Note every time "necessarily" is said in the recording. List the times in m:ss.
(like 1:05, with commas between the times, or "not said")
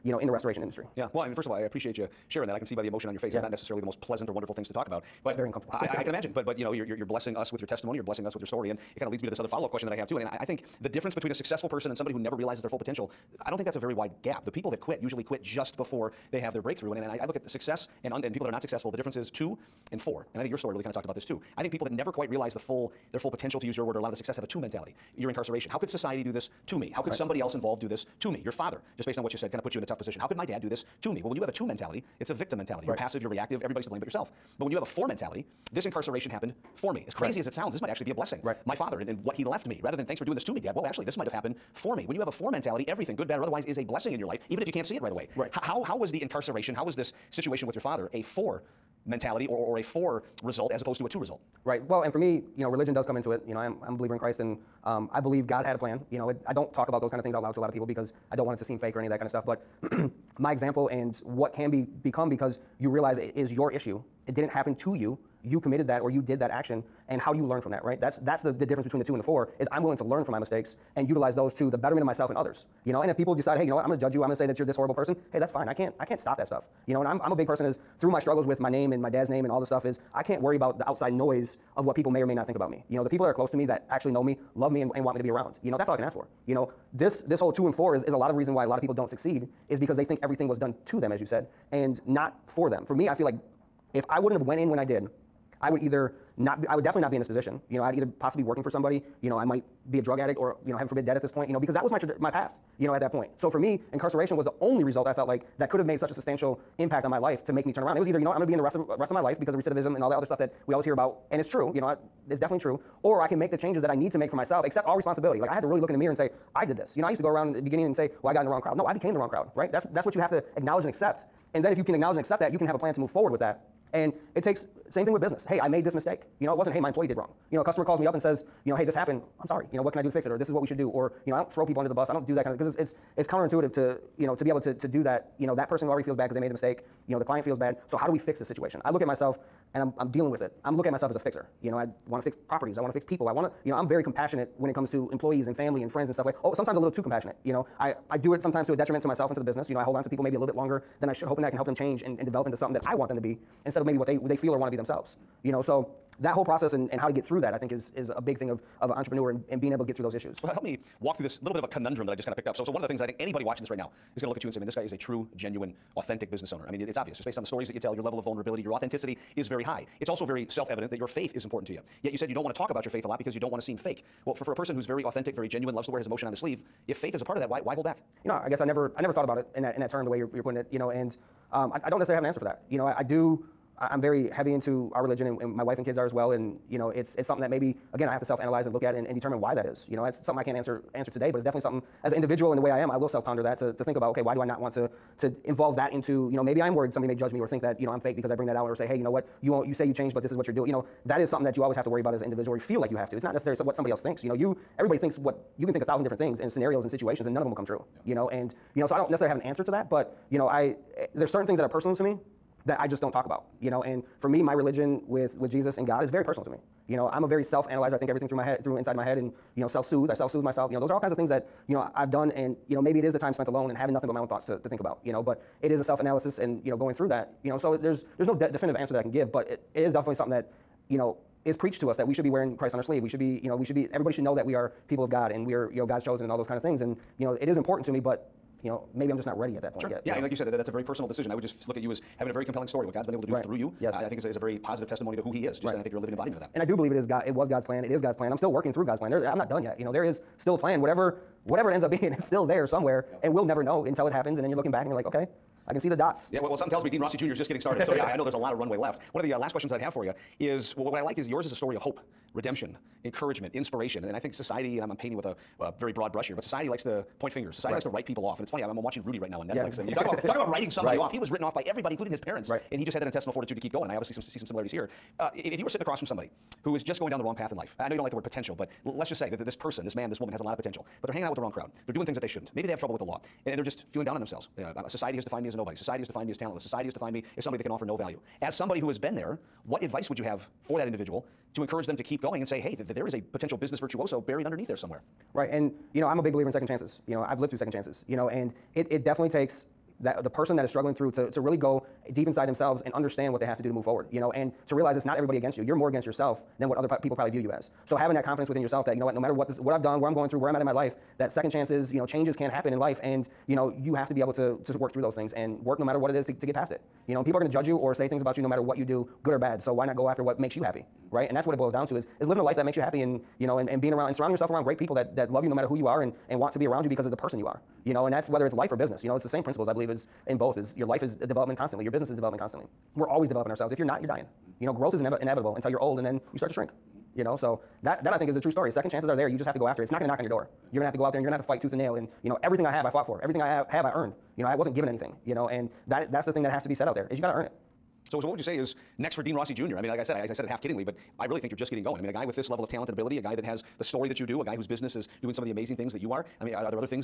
0:03, 3:01, 3:23, 3:29.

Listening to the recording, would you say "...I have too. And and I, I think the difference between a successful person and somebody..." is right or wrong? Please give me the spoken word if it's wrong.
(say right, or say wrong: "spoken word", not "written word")
right.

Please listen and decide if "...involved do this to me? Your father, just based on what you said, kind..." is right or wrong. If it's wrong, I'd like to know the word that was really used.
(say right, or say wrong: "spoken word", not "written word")
right.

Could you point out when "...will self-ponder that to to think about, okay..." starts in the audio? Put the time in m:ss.
3:12.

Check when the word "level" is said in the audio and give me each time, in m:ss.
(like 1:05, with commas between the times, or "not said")
2:48, 5:52.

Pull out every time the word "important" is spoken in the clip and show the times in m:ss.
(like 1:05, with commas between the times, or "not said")
2:51, 3:57.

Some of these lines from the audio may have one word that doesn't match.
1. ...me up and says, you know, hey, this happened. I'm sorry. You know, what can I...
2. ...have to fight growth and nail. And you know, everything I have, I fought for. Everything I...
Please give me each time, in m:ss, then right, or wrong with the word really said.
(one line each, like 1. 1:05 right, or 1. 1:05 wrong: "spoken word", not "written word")
1. 2:07 right
2. 5:41 wrong: "tooth", not "growth".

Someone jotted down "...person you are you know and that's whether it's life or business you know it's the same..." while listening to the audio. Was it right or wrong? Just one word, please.
right.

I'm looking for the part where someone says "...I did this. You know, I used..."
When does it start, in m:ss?
1:56.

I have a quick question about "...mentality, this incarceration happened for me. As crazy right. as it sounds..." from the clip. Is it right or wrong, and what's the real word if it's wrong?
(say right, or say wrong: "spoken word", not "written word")
right.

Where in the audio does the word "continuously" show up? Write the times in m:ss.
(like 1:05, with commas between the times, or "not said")
not said.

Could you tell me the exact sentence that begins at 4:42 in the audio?
Maybe they have trouble with the law, and they're just feeling down on themselves.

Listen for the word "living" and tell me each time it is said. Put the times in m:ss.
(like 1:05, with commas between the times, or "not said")
4:05, 5:22.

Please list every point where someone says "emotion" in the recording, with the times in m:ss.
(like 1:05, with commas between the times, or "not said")
0:02, 2:56.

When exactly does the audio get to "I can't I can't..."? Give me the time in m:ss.
1:15.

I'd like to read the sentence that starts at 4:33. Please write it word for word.
And I obviously some, see some similarities here.